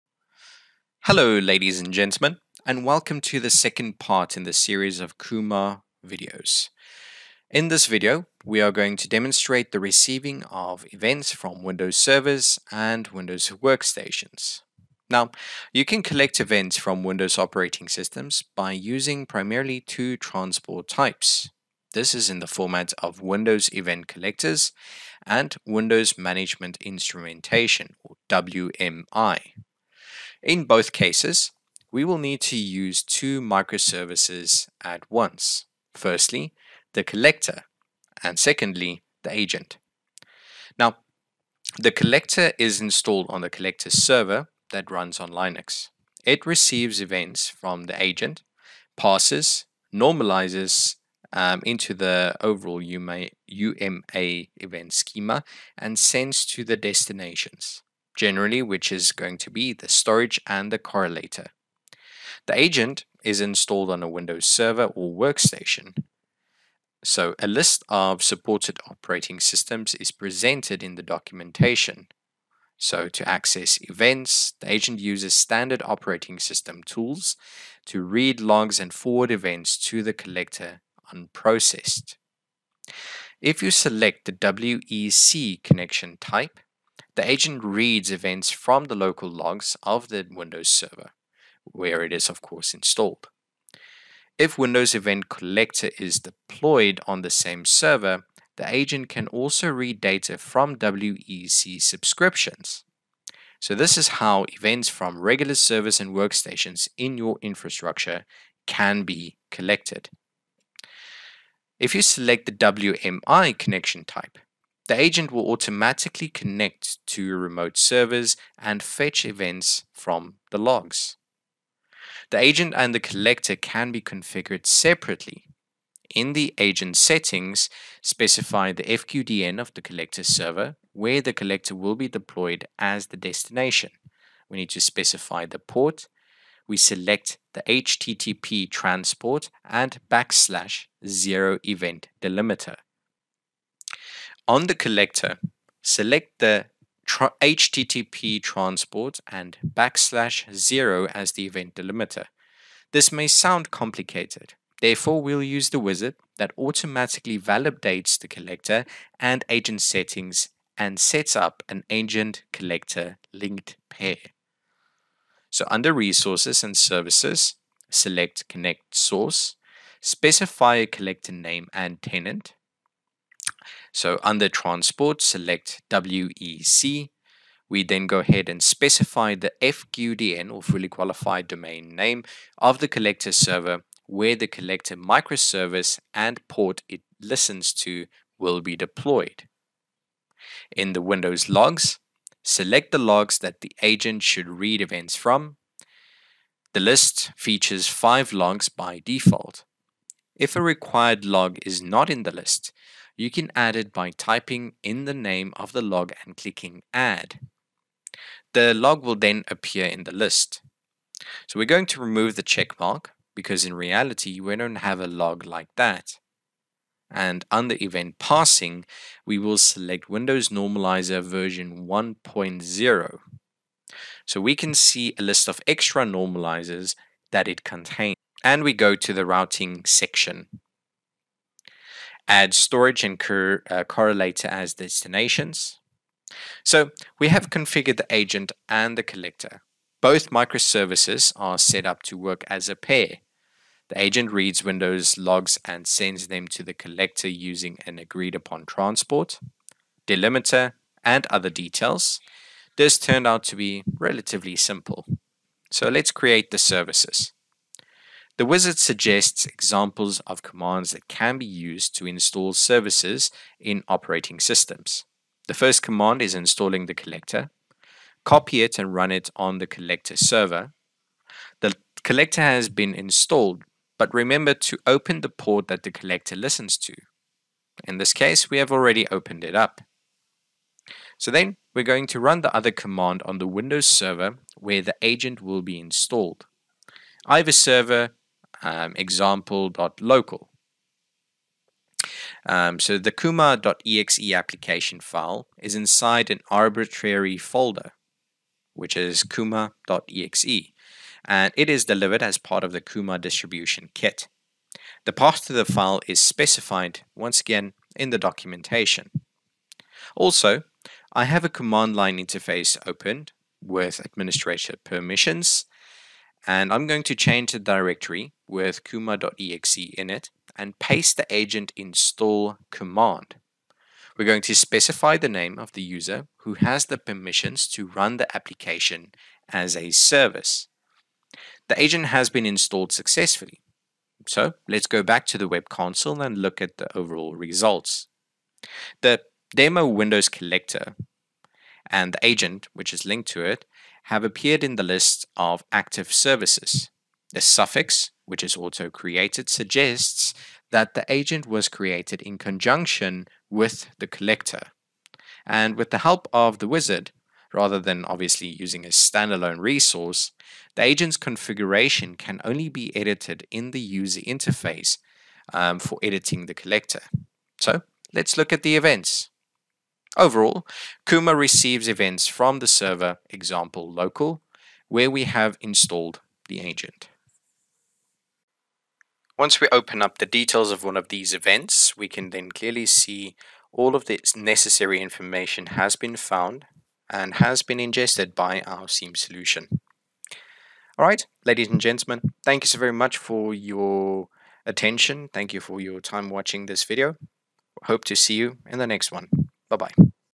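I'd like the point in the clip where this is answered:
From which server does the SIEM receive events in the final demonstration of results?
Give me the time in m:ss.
6:13.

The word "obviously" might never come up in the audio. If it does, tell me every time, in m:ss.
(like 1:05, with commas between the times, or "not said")
5:58.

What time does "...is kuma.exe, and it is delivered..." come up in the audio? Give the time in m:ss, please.
4:58.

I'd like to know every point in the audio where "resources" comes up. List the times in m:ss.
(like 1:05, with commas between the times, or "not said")
2:45, 5:59.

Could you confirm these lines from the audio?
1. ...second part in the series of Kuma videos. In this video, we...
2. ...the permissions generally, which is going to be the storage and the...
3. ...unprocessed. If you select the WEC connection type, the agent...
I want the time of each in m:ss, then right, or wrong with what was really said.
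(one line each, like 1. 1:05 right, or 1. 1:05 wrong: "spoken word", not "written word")
1. 0:03 right
2. 0:56 wrong: "destinations", not "permissions"
3. 1:21 right.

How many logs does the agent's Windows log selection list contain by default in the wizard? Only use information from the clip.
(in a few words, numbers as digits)
5.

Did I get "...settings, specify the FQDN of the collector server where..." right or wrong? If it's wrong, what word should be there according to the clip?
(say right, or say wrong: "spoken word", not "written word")
right.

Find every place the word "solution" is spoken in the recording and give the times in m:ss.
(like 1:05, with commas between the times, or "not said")
6:29.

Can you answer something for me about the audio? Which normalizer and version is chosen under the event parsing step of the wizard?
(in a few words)
Windows Normalizer 1.0.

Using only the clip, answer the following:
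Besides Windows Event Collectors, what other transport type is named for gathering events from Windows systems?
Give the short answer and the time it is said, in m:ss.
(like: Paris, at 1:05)
Windows Management Instrumentation, at 0:25.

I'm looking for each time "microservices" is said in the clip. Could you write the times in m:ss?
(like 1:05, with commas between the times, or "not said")
0:33, 3:04, 4:00.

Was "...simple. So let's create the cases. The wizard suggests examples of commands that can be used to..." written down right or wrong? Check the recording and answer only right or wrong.
wrong.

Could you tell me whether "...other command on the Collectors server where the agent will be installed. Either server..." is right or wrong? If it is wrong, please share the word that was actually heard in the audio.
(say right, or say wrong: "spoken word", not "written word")
wrong: "Windows", not "Collectors".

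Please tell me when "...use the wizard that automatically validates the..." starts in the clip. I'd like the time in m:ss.
2:35.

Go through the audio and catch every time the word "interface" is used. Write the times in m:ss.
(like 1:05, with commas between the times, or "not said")
5:12, 6:04.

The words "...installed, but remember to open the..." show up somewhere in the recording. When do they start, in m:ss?
4:32.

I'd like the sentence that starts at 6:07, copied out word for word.
So let's look at the events.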